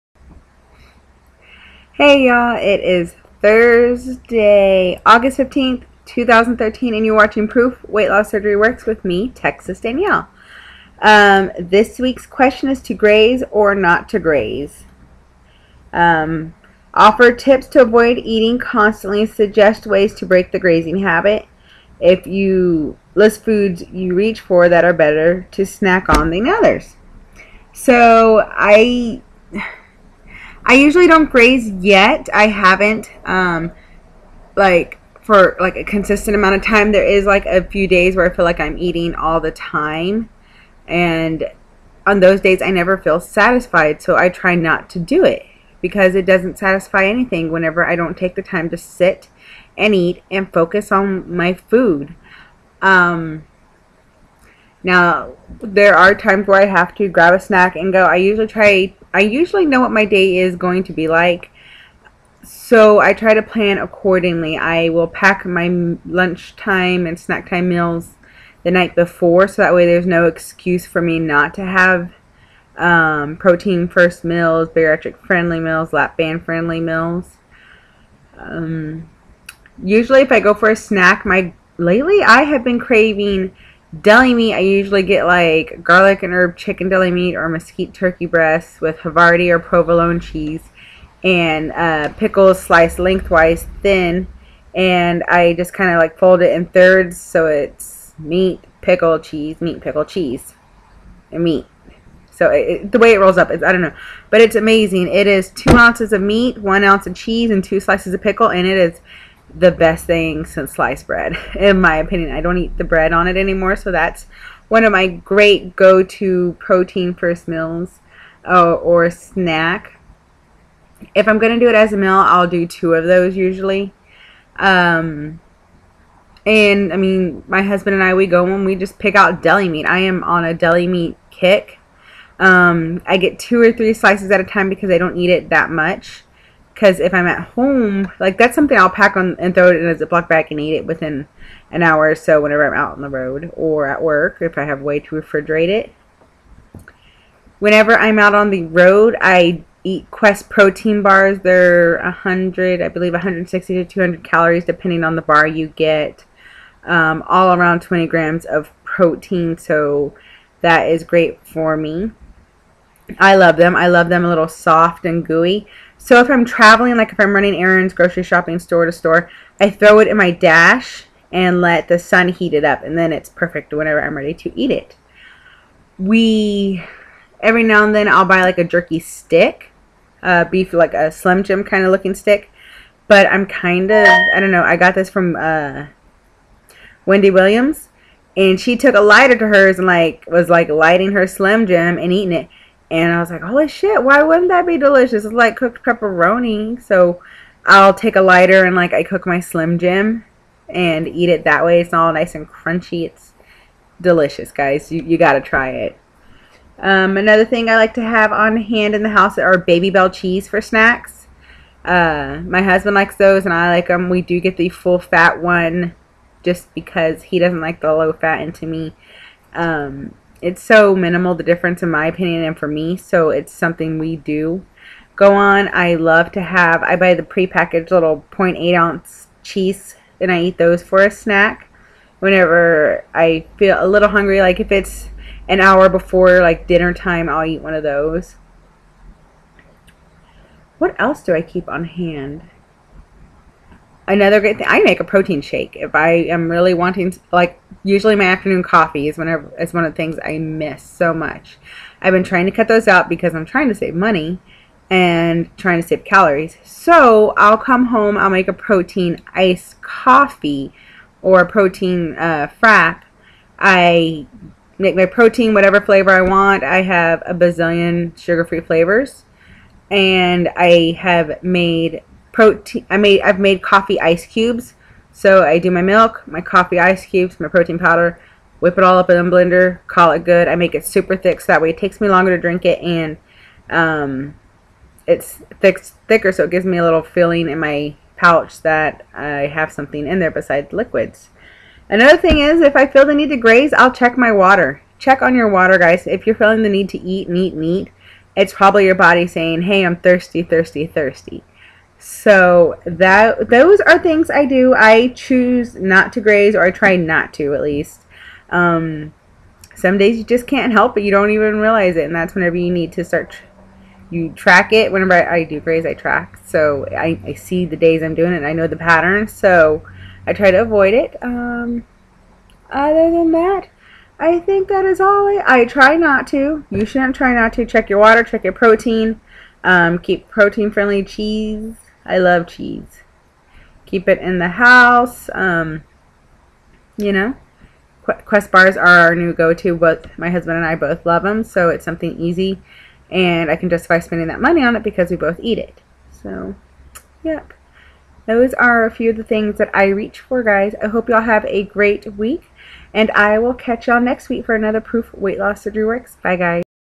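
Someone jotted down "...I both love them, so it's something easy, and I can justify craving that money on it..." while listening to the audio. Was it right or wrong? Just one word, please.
wrong.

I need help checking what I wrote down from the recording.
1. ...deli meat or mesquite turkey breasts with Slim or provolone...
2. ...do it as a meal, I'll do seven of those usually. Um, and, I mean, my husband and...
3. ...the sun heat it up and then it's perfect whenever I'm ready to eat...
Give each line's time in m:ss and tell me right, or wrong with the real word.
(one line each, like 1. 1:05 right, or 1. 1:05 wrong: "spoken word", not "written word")
1. 1:26 wrong: "Havarti", not "Slim"
2. 2:01 wrong: "two", not "seven"
3. 2:51 right.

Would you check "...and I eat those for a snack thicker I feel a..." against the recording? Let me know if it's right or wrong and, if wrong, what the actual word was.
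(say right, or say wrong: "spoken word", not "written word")
wrong: "whenever", not "thicker".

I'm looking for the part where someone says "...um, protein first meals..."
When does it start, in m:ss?
1:12.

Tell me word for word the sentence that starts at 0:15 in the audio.
Um, offer tips to avoid eating constantly, suggest ways to break the grazing habit.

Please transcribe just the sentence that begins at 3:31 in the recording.
Uh, my husband likes those and I like them.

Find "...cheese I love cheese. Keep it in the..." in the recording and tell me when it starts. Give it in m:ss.
5:31.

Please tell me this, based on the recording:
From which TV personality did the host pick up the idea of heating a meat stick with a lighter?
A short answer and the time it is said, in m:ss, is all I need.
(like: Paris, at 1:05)
Wendy Williams, at 3:07.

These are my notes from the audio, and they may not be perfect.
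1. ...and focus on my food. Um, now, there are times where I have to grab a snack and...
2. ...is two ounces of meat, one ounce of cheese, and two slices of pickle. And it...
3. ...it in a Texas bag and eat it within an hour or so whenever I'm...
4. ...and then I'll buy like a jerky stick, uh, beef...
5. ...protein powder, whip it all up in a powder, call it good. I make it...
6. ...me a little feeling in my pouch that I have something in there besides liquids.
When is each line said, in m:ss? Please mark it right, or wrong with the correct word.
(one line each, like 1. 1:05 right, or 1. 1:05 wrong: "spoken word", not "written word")
1. 0:50 right
2. 1:45 right
3. 2:19 wrong: "Ziploc", not "Texas"
4. 2:57 right
5. 4:37 wrong: "blender", not "powder"
6. 4:46 right.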